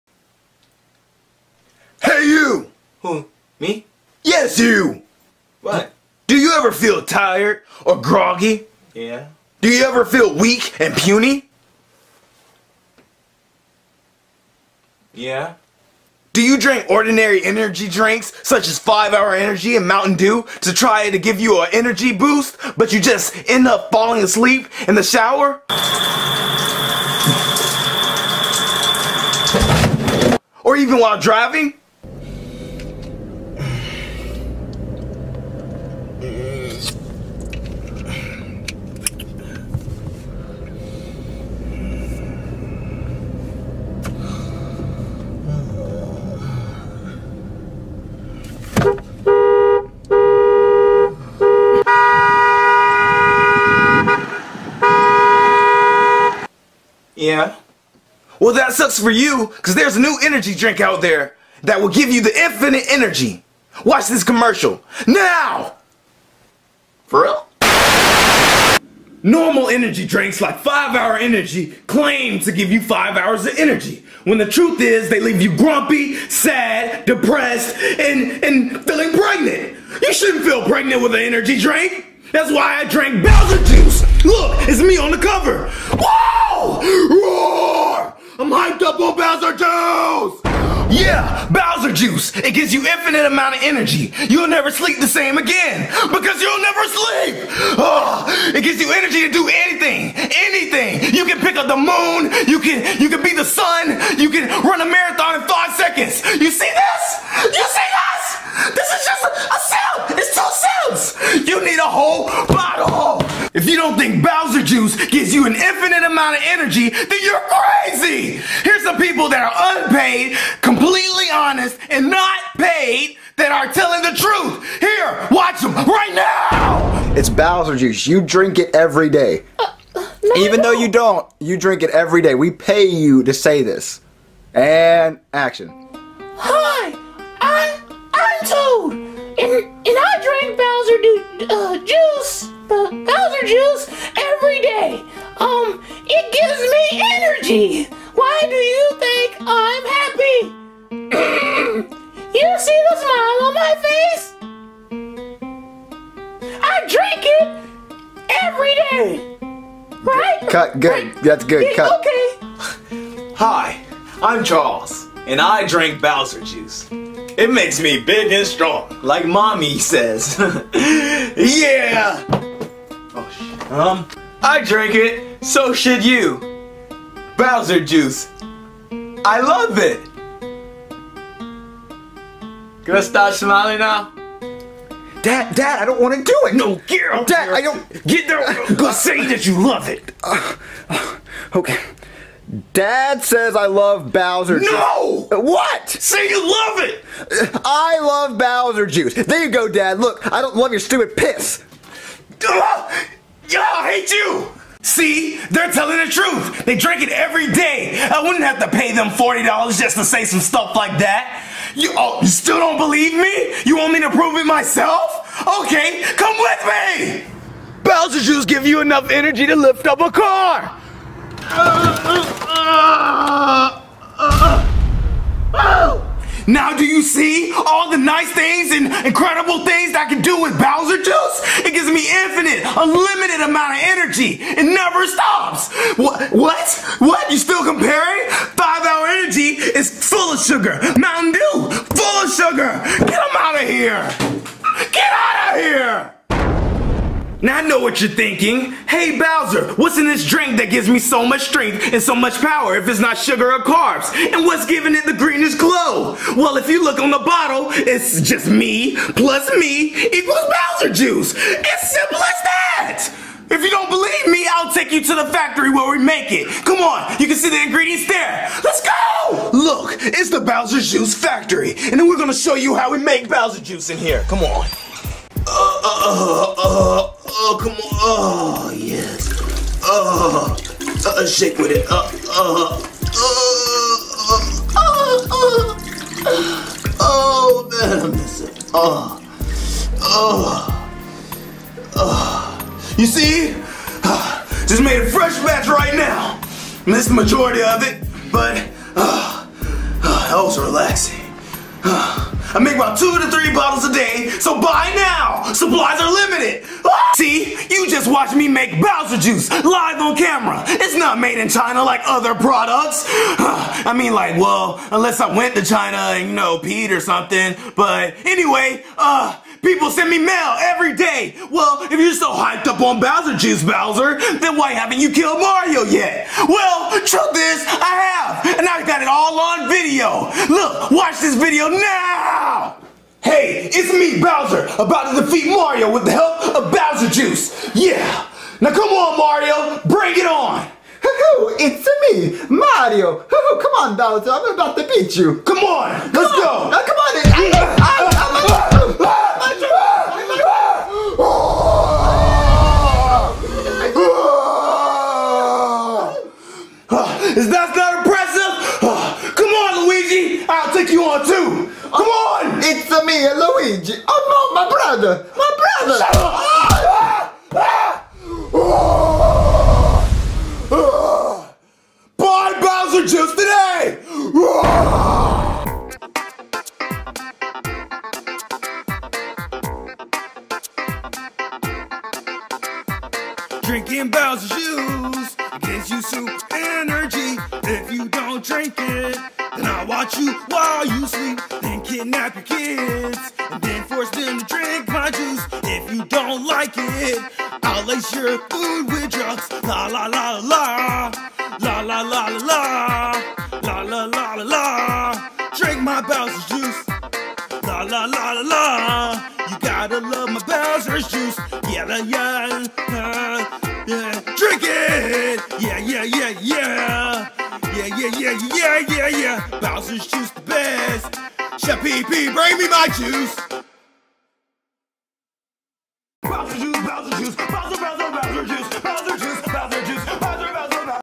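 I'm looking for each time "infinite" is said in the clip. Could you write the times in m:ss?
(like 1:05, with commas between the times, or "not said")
1:02, 1:32, 1:55, 3:52.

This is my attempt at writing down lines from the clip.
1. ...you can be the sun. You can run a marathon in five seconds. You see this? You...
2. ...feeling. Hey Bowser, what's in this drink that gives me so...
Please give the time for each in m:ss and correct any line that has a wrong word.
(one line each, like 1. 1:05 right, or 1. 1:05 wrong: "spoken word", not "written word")
1. 1:43 right
2. 4:08 wrong: "thinking", not "feeling".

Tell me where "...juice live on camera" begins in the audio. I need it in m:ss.
5:09.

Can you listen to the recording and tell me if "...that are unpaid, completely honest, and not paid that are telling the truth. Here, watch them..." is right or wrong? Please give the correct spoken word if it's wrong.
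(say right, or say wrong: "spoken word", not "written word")
right.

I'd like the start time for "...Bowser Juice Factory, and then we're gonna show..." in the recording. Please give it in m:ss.
4:30.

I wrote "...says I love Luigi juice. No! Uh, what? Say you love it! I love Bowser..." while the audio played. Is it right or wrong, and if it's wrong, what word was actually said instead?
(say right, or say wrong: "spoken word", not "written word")
wrong: "Bowser", not "Luigi".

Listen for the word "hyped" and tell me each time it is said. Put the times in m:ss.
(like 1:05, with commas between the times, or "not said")
1:28, 5:22.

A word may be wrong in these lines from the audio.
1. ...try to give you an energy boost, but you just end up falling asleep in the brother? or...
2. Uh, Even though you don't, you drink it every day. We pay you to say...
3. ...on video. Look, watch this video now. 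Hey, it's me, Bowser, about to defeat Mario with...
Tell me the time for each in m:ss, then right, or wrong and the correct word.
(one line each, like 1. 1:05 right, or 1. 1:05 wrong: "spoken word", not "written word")
1. 0:20 wrong: "shower", not "brother"
2. 2:09 right
3. 5:29 right.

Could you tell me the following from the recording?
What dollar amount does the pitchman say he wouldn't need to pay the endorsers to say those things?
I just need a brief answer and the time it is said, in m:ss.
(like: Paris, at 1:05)
$40, at 3:29.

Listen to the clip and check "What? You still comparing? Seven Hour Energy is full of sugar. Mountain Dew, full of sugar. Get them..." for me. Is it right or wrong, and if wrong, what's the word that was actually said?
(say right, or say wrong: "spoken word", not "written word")
wrong: "Five", not "Seven".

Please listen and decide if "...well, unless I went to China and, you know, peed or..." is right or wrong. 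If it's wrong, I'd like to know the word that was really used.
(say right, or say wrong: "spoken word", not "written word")
right.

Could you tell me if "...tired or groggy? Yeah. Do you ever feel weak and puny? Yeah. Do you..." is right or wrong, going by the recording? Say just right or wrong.
right.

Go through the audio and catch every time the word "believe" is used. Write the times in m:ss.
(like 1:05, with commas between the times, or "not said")
3:32, 4:23.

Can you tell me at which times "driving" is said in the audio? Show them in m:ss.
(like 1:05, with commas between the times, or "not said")
0:31.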